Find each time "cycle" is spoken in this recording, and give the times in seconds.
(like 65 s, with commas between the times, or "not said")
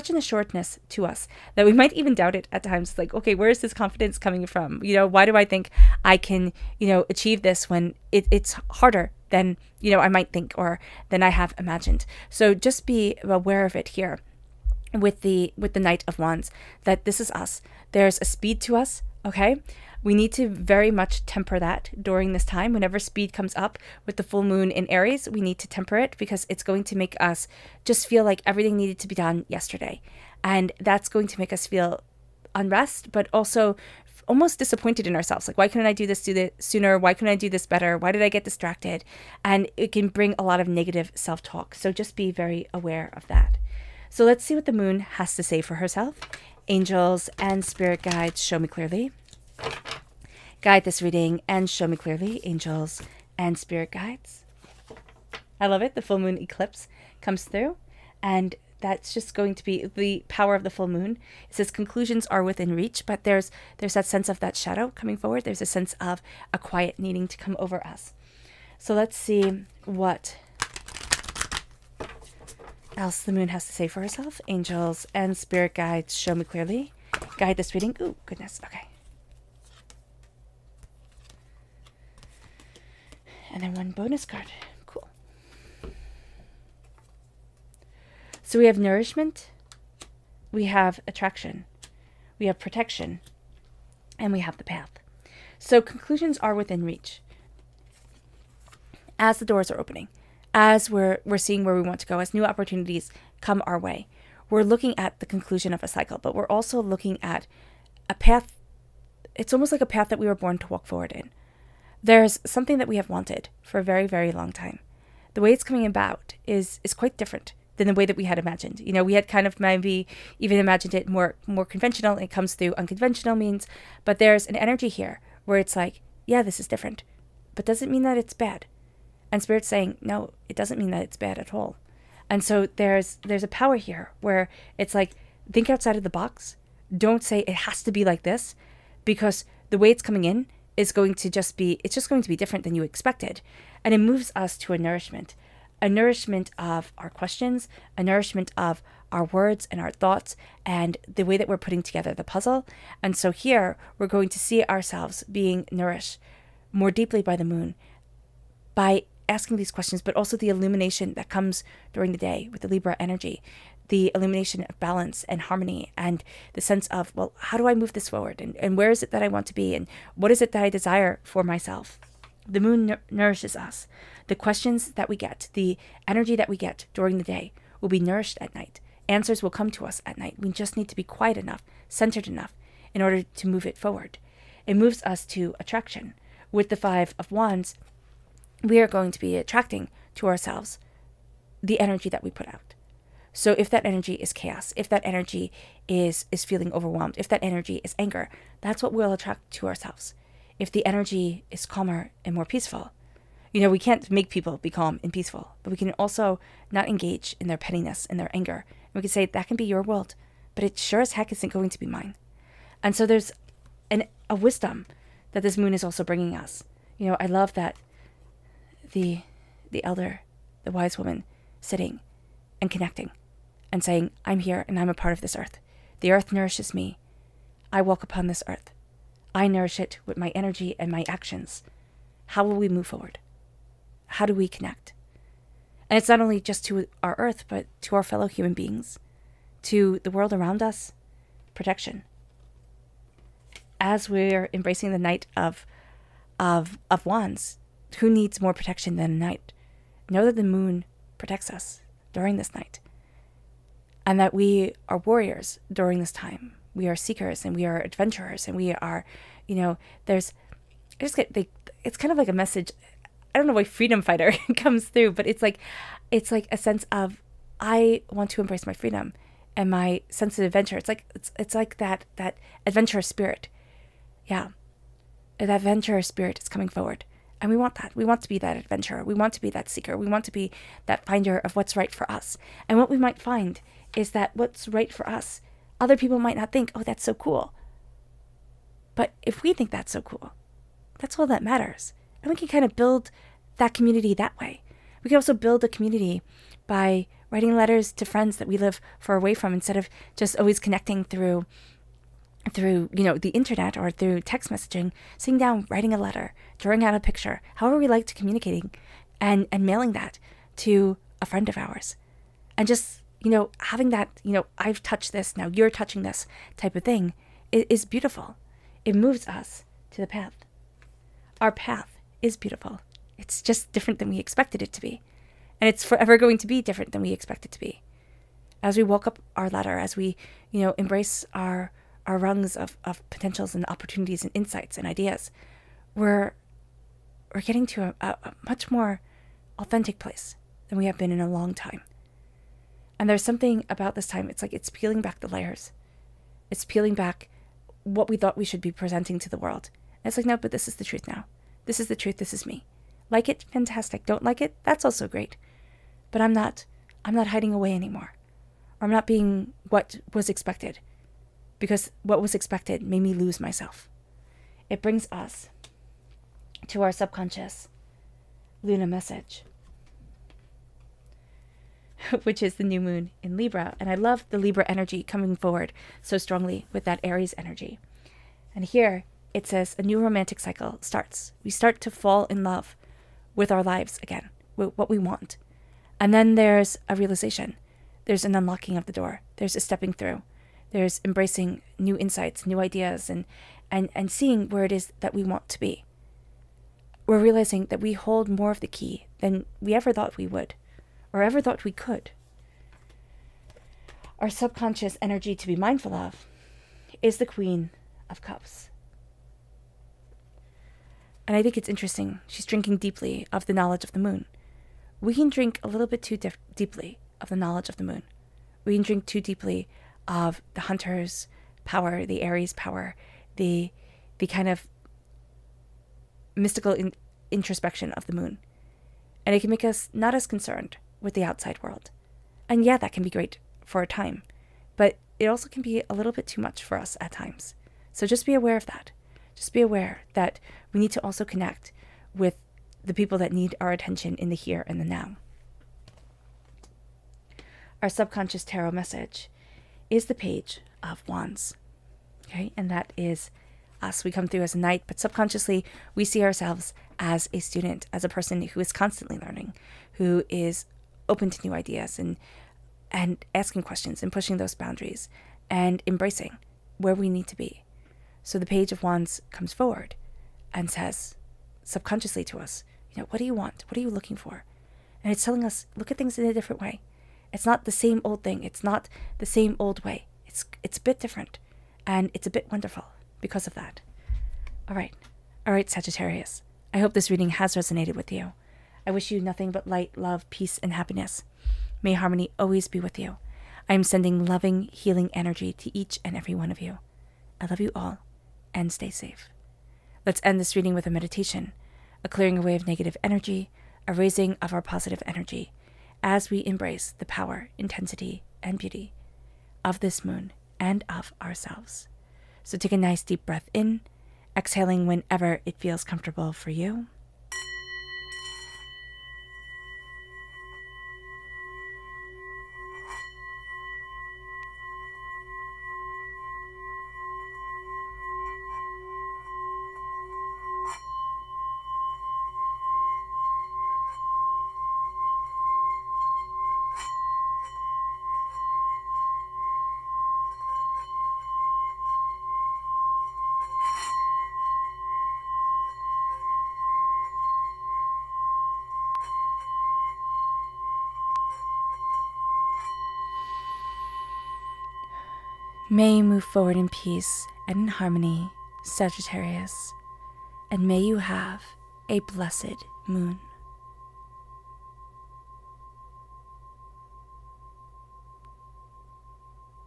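105 s, 380 s.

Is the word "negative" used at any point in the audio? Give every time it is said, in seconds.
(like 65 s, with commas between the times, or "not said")
40 s, 502 s.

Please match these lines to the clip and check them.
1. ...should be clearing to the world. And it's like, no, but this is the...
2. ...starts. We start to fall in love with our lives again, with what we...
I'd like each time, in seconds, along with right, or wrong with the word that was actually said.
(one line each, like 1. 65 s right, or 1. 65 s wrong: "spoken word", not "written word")
1. 348 s wrong: "presenting", not "clearing"
2. 380 s right.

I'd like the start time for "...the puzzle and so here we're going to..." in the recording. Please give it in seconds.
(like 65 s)
152 s.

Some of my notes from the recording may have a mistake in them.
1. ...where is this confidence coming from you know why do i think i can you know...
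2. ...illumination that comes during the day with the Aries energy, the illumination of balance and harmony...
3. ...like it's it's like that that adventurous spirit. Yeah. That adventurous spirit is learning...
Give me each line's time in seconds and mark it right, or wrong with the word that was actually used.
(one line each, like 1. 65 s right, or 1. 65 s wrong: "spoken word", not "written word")
1. 3 s right
2. 160 s wrong: "Libra", not "Aries"
3. 270 s wrong: "coming", not "learning".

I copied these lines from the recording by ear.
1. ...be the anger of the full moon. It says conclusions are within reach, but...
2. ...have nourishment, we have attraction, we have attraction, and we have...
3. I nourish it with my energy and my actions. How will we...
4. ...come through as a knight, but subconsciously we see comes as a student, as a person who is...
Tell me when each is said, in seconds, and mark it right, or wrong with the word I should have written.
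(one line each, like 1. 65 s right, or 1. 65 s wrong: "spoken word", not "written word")
1. 59 s wrong: "power", not "anger"
2. 88 s wrong: "protection", not "attraction"
3. 229 s right
4. 454 s wrong: "ourselves", not "comes".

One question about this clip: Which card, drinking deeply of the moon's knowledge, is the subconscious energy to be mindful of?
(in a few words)
Queen of Cups.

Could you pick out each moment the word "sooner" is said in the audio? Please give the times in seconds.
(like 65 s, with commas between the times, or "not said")
36 s.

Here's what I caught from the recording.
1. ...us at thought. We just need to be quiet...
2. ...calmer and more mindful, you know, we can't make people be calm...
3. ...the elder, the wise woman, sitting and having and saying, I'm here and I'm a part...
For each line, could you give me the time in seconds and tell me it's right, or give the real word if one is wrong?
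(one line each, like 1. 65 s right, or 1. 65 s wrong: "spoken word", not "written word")
1. 179 s wrong: "night", not "thought"
2. 201 s wrong: "peaceful", not "mindful"
3. 219 s wrong: "connecting", not "having".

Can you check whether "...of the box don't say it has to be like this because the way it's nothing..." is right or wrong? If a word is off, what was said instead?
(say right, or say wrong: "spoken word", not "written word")
wrong: "coming", not "nothing".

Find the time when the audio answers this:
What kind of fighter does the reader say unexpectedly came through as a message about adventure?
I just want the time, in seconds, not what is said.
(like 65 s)
263 s.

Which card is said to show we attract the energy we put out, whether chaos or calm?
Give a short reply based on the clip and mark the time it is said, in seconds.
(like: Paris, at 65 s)
Five of Wands, at 186 s.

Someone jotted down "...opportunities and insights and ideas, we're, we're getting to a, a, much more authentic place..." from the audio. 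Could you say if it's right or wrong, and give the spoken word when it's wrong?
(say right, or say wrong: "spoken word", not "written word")
right.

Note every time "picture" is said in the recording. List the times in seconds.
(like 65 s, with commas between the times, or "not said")
306 s.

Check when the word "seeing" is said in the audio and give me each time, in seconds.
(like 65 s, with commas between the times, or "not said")
101 s, 394 s.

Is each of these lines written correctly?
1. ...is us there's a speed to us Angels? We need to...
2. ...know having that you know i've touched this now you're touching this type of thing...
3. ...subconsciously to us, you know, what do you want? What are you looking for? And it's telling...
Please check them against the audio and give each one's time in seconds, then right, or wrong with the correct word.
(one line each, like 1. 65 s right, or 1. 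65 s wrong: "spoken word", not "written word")
1. 17 s wrong: "Okay", not "Angels"
2. 313 s right
3. 471 s right.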